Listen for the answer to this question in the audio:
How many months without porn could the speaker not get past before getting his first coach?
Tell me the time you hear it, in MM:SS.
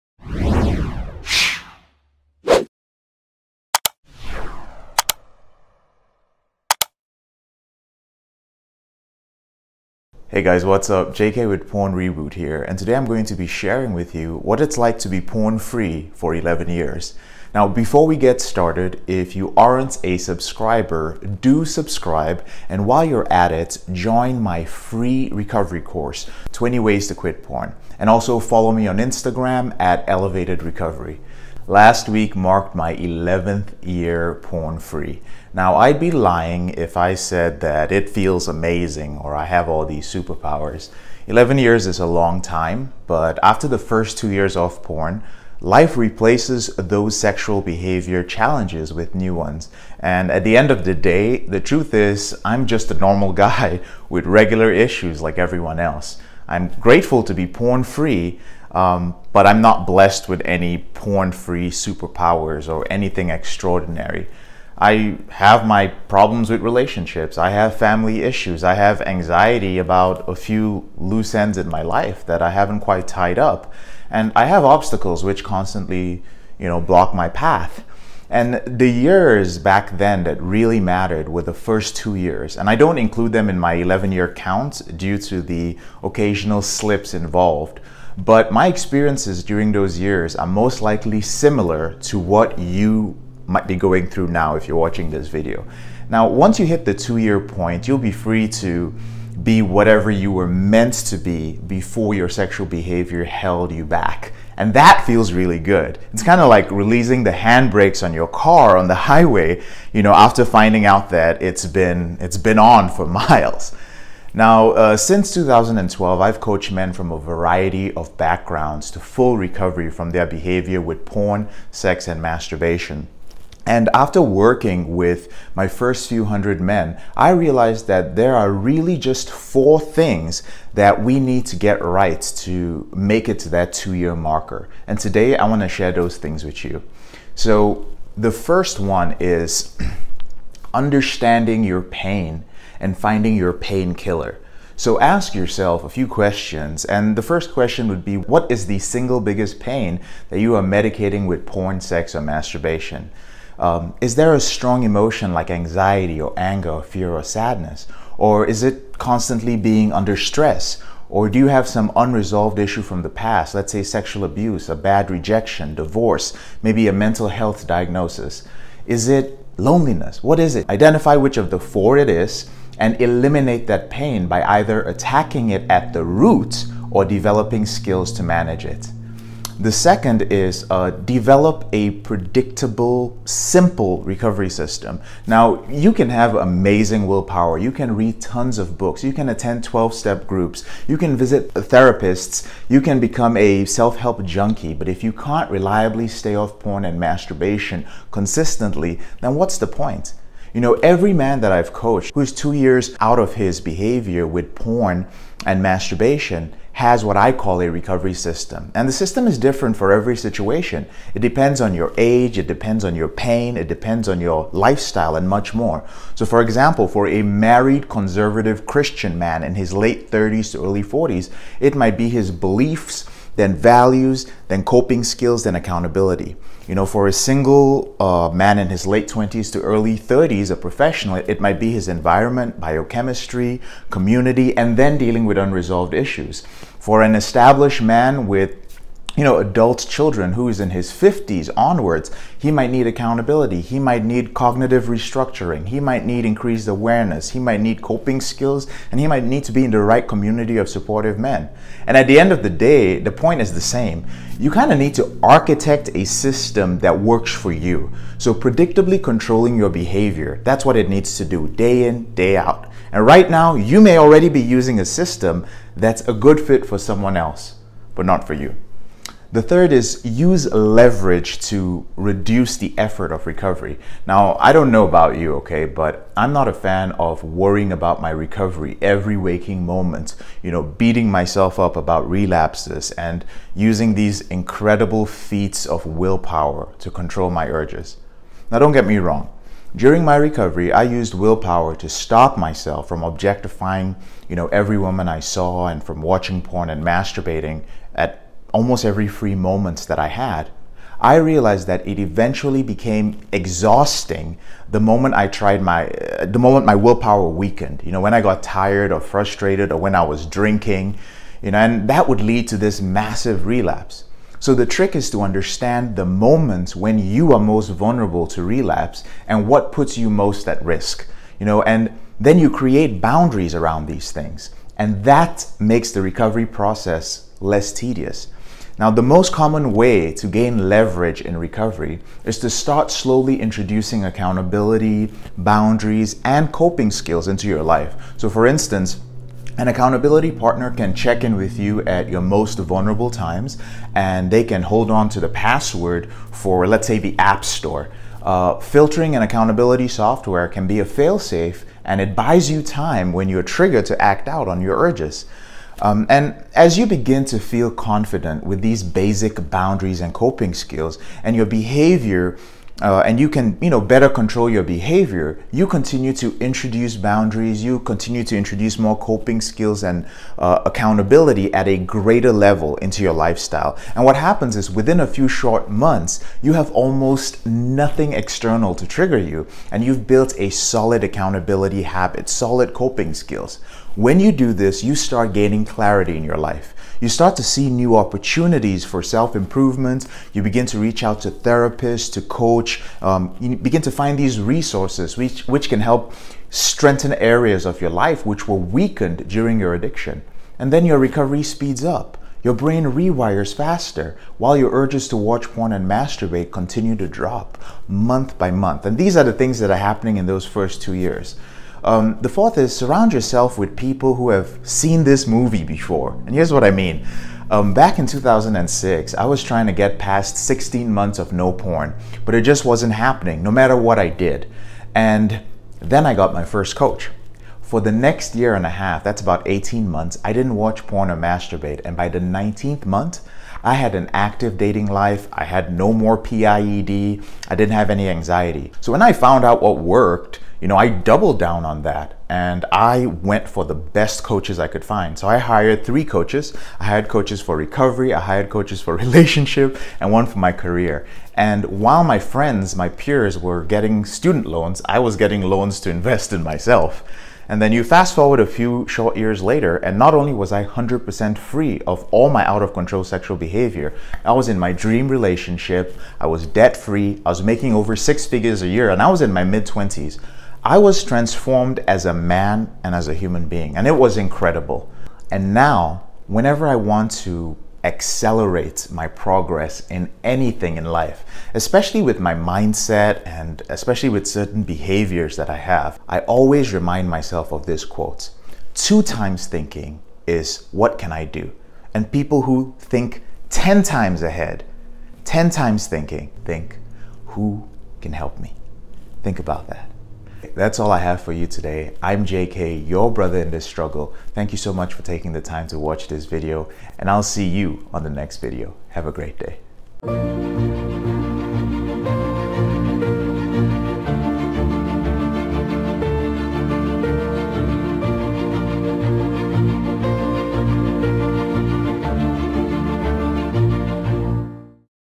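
07:00.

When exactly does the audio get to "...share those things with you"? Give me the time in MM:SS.
02:15.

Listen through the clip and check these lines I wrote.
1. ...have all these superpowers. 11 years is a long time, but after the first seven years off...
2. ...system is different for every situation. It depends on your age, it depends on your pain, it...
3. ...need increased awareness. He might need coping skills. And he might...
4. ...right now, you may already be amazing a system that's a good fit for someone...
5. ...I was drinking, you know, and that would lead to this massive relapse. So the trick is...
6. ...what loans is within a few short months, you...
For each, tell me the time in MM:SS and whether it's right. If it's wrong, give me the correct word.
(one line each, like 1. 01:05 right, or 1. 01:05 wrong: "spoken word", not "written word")
1. 00:39 wrong: "two", not "seven"
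2. 03:28 right
3. 04:06 right
4. 04:23 wrong: "using", not "amazing"
5. 05:09 right
6. 06:14 wrong: "happens", not "loans".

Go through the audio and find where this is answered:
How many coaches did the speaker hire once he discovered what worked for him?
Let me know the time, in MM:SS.
07:25.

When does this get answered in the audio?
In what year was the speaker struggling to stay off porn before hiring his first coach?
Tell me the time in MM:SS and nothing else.
06:58.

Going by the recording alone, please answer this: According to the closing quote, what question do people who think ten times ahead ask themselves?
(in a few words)
Who can help me?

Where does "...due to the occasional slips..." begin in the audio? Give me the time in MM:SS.
01:24.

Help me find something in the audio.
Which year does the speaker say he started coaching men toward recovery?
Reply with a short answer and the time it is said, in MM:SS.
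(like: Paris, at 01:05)
2012, at 01:55.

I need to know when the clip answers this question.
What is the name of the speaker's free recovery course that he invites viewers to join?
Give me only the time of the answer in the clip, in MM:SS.
00:26.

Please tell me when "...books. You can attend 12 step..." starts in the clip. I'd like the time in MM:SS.
03:08.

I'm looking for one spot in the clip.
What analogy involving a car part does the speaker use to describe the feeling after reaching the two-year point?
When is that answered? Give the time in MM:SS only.
01:47.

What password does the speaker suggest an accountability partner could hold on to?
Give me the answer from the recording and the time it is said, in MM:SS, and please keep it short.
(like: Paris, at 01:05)
App Store, at 05:47.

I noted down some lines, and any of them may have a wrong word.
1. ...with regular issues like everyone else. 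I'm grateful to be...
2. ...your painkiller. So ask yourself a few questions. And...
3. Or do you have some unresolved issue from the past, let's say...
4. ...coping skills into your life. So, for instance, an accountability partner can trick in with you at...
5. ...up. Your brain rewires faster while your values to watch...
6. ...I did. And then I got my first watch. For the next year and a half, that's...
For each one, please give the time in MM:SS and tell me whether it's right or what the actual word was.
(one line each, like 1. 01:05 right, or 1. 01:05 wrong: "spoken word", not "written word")
1. 00:54 right
2. 02:23 right
3. 02:41 right
4. 05:36 wrong: "check", not "trick"
5. 06:41 wrong: "urges", not "values"
6. 07:03 wrong: "coach", not "watch".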